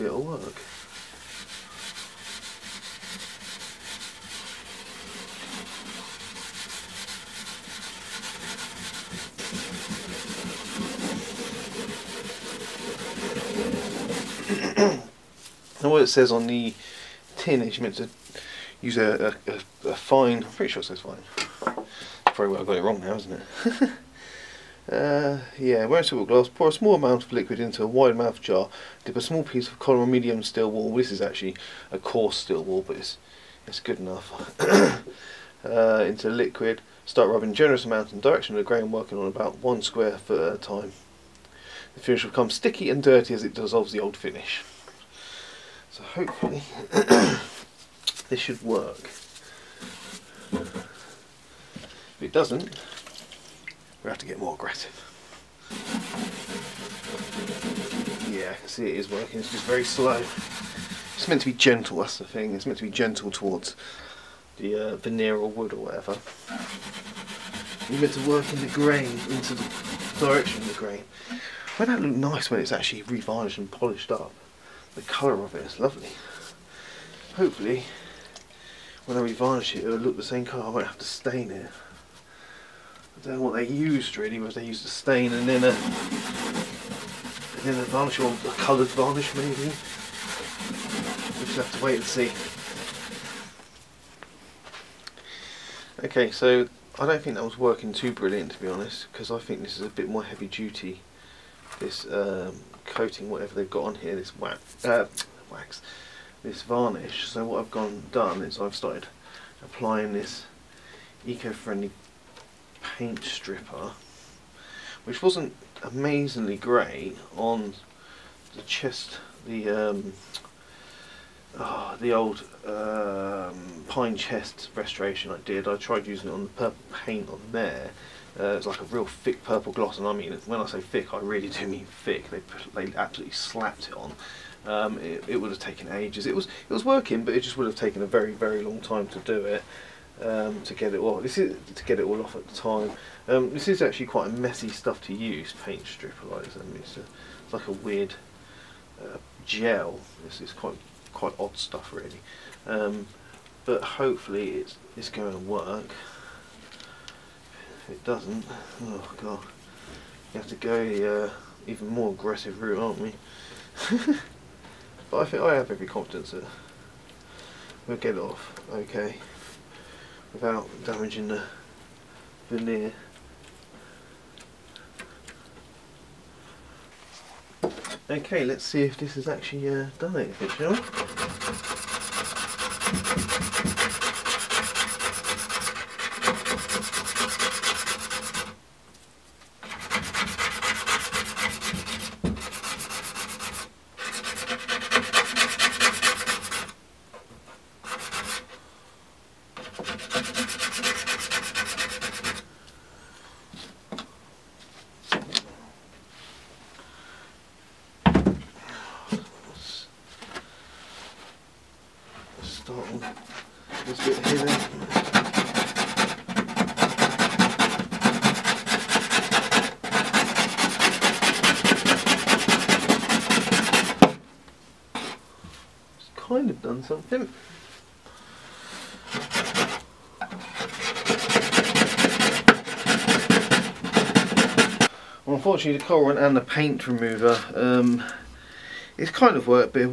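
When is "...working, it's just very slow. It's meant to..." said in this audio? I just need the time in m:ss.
0:59.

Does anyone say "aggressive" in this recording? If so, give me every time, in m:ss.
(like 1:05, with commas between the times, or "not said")
0:54, 2:42.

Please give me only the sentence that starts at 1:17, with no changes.
Hopefully, when I revarnish it, it'll look the same colour.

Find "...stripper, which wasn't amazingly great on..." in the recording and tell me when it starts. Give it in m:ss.
1:53.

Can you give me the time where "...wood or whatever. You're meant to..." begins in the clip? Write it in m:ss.
1:05.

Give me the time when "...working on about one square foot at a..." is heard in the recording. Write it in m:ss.
0:38.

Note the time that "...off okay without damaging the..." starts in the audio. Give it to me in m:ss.
2:48.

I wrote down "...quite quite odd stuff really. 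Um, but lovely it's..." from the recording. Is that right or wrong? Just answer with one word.
wrong.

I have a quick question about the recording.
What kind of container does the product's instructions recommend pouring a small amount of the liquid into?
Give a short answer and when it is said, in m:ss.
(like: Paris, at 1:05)
wide mouth jar, at 0:27.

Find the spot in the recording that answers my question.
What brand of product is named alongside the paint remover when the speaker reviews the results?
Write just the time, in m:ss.
3:55.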